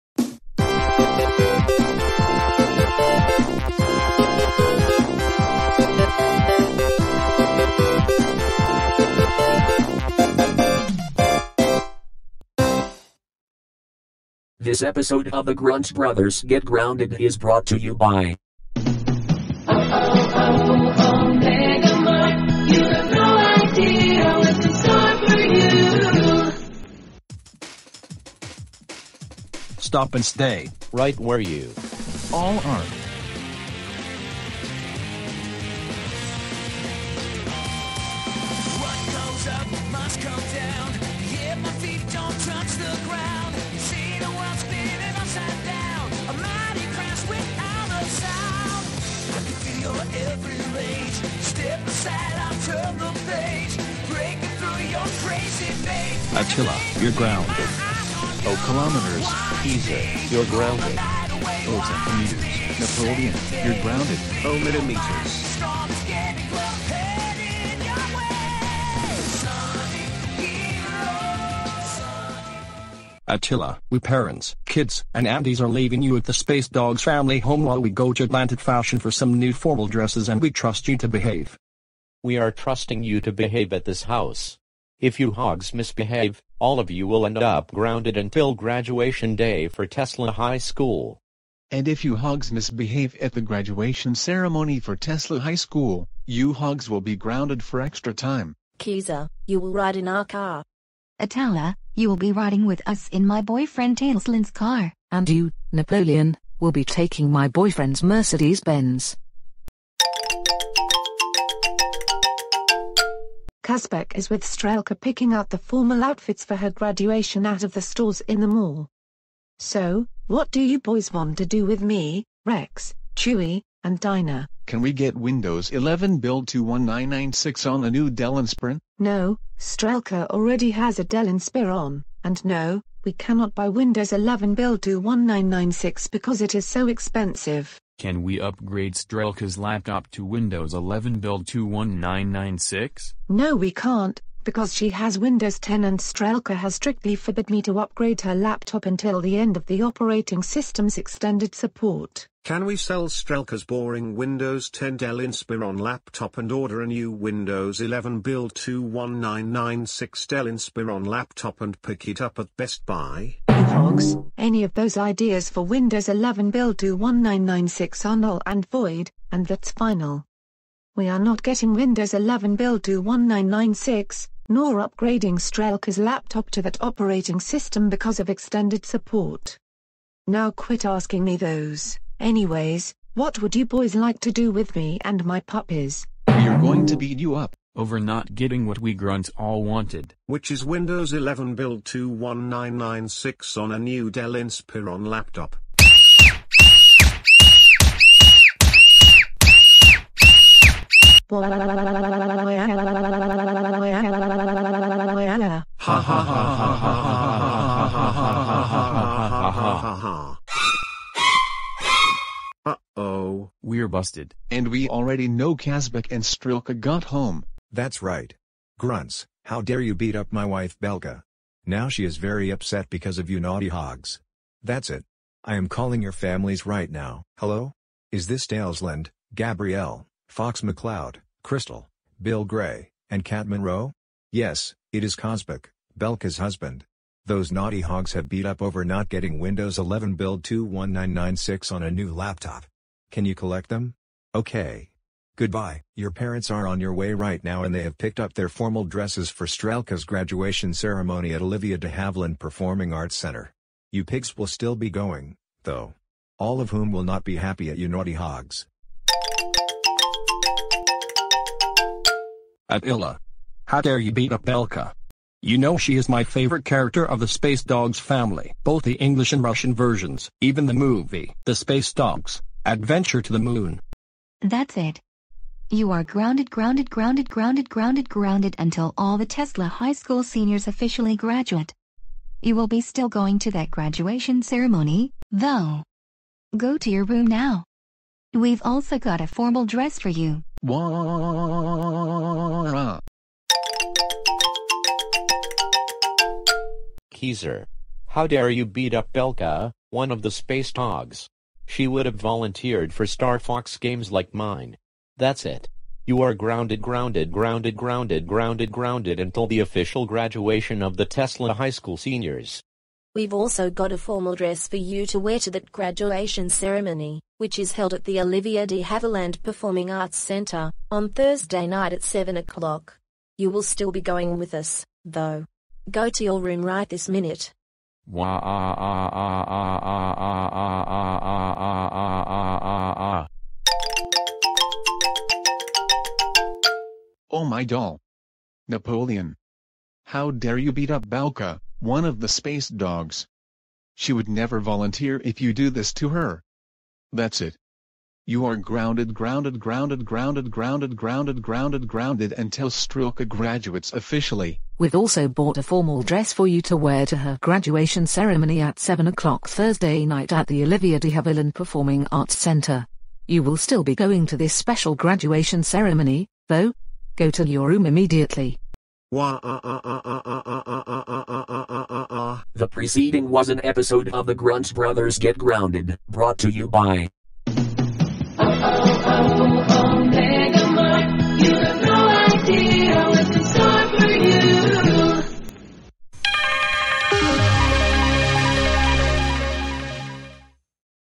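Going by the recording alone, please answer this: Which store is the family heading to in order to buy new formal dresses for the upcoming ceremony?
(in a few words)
Atlantic Fashion.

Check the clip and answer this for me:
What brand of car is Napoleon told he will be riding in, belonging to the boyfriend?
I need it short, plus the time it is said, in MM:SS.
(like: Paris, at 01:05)
Mercedes-Benz, at 01:48.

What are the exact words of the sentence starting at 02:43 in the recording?
Hogs, any of those ideas for Windows 11 build 21996 are null and void, and that's final.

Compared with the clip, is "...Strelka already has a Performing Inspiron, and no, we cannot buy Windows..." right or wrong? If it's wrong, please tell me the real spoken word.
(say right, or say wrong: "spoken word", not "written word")
wrong: "Dell", not "Performing".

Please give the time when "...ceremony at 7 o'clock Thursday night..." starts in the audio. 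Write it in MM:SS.
05:58.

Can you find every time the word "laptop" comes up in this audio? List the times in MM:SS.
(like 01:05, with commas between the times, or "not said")
02:19, 02:28, 02:35, 02:41, 02:55, 03:15, 04:02.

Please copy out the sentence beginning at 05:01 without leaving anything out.
She would have volunteered for Star Fox games like mine.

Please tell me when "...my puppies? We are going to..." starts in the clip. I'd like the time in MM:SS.
03:05.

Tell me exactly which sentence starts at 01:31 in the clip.
And if you hogs misbehave at the graduation ceremony for Tesla High School, you hogs will be grounded for extra time.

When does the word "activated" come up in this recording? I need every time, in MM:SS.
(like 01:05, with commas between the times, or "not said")
not said.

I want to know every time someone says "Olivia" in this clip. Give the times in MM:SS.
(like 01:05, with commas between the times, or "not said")
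04:11, 05:18, 06:00.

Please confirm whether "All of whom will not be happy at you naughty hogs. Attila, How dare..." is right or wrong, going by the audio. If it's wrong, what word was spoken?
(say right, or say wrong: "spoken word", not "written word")
right.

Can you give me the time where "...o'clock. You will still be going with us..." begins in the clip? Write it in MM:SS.
05:22.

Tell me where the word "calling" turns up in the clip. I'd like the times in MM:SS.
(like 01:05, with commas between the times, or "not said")
03:45.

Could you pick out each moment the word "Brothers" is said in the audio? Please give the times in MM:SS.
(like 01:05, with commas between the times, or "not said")
00:15, 06:14.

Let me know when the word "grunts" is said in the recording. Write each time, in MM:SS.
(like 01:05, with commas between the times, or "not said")
00:15, 03:08, 03:38, 06:14.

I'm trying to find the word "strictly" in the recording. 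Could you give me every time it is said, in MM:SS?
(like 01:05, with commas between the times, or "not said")
02:26.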